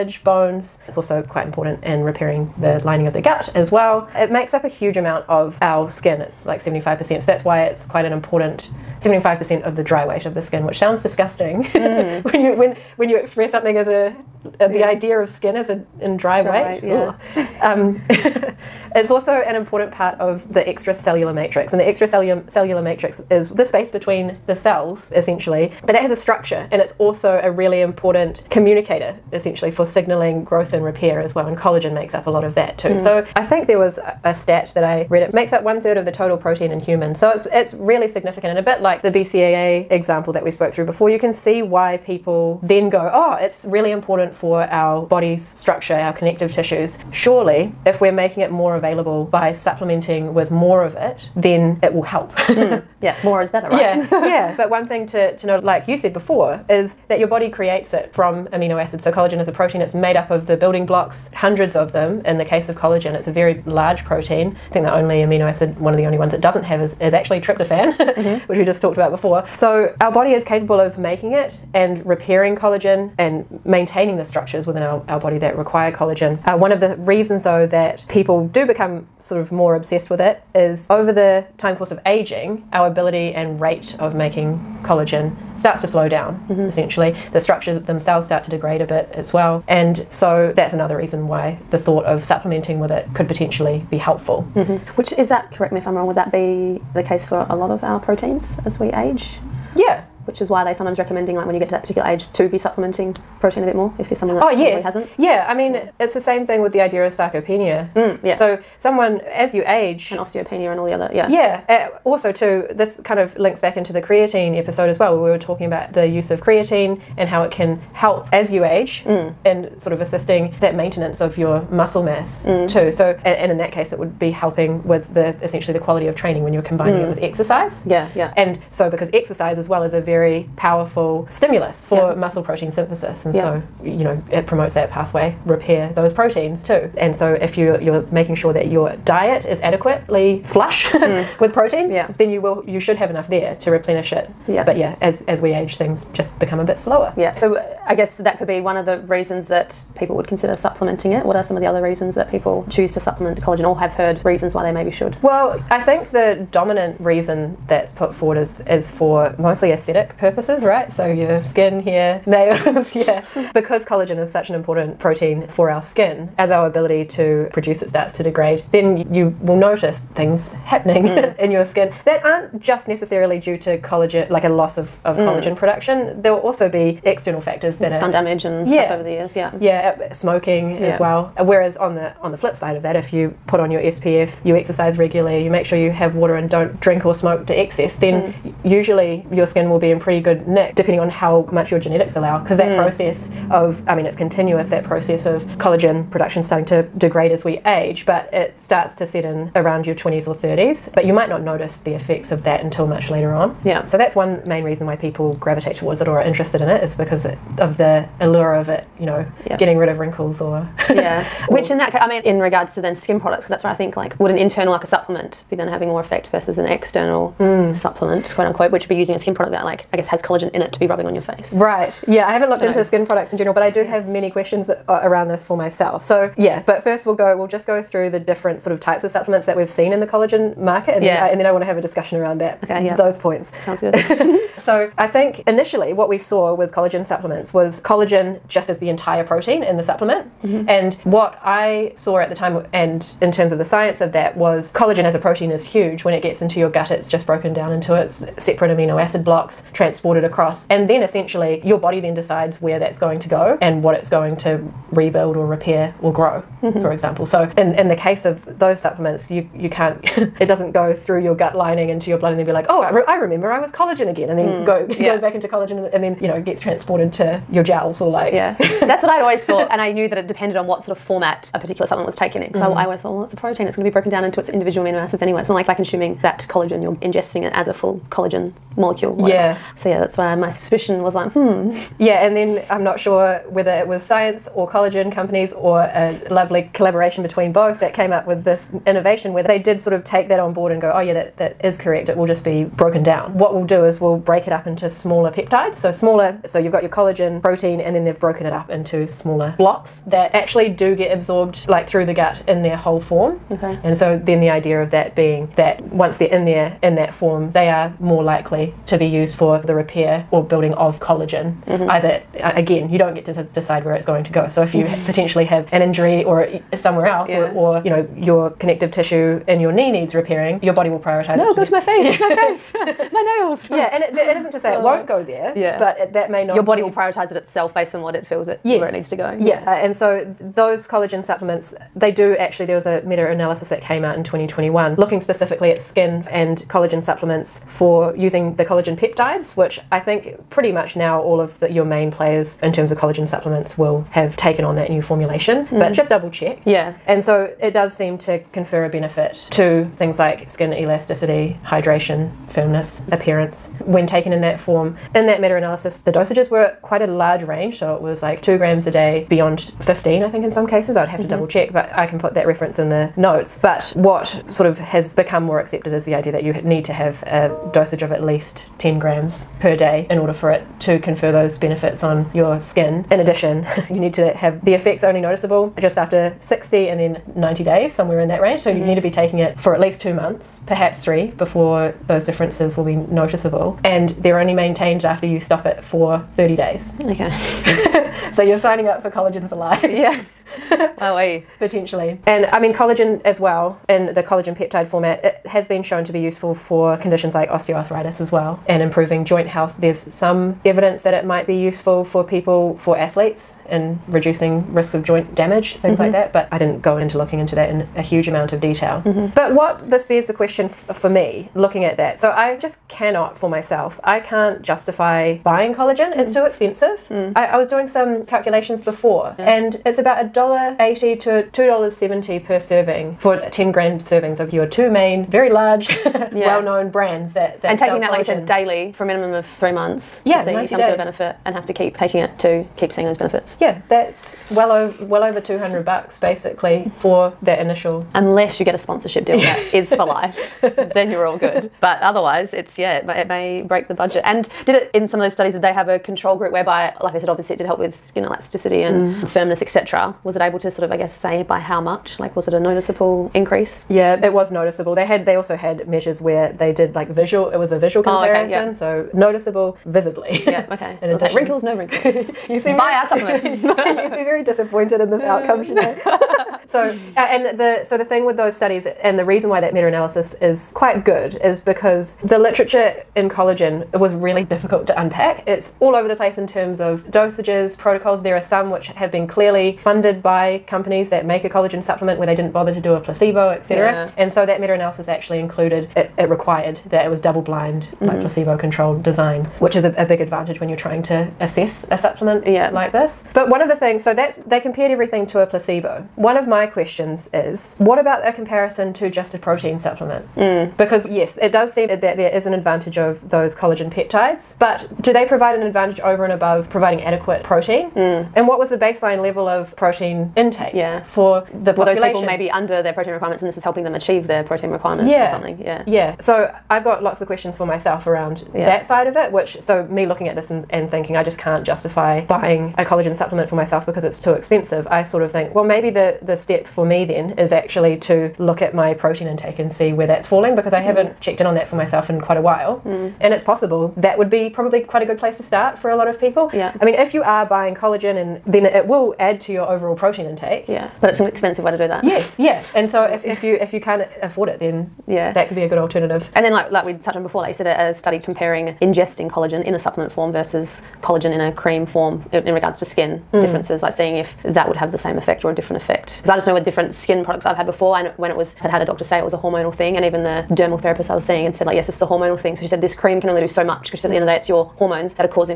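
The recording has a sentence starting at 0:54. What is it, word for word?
But one thing to, to know, like you said before, is that your body creates it from amino acids.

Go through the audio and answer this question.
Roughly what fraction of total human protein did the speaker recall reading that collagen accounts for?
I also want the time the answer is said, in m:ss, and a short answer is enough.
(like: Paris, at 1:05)
one third, at 0:35.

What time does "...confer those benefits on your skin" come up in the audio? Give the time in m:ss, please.
6:10.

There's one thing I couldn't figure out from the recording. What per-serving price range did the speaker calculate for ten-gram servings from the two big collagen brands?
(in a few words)
$1.80 to $2.70.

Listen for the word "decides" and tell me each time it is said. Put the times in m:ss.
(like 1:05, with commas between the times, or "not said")
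4:12, 5:13.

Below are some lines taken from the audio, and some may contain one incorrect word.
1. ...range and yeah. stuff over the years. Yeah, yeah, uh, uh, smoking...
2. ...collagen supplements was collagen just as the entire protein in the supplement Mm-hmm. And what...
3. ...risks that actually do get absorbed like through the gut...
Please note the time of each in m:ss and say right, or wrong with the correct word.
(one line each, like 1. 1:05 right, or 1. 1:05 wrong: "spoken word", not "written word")
1. 2:58 wrong: "damage", not "range"
2. 3:56 right
3. 4:59 wrong: "blocks", not "risks".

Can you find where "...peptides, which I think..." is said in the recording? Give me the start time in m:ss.
5:38.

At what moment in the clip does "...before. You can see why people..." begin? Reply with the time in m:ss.
0:40.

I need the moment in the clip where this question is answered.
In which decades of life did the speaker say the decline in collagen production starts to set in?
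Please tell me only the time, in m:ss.
3:19.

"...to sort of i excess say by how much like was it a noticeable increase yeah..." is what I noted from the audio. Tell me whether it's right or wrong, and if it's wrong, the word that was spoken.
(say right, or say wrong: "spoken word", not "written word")
wrong: "guess", not "excess".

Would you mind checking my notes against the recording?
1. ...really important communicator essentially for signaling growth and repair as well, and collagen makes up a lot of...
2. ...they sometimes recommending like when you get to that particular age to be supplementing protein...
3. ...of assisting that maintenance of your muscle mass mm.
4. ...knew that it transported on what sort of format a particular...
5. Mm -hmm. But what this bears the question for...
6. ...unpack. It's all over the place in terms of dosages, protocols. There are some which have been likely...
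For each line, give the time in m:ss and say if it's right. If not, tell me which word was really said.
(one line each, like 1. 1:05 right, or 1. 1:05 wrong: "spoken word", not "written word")
1. 0:27 right
2. 1:40 right
3. 1:59 right
4. 4:29 wrong: "depended", not "transported"
5. 6:49 right
6. 7:54 wrong: "clearly", not "likely".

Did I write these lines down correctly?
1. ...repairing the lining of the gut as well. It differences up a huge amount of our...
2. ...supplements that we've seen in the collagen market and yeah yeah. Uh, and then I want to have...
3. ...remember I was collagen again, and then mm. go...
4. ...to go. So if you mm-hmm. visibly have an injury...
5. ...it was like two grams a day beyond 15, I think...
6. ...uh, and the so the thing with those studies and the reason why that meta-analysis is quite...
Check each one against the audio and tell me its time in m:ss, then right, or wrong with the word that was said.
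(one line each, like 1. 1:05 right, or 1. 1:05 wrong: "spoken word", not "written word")
1. 0:02 wrong: "makes", not "differences"
2. 3:49 right
3. 4:23 right
4. 5:14 wrong: "potentially", not "visibly"
5. 5:57 right
6. 7:47 right.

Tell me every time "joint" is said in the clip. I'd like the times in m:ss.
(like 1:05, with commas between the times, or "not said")
6:39, 6:45.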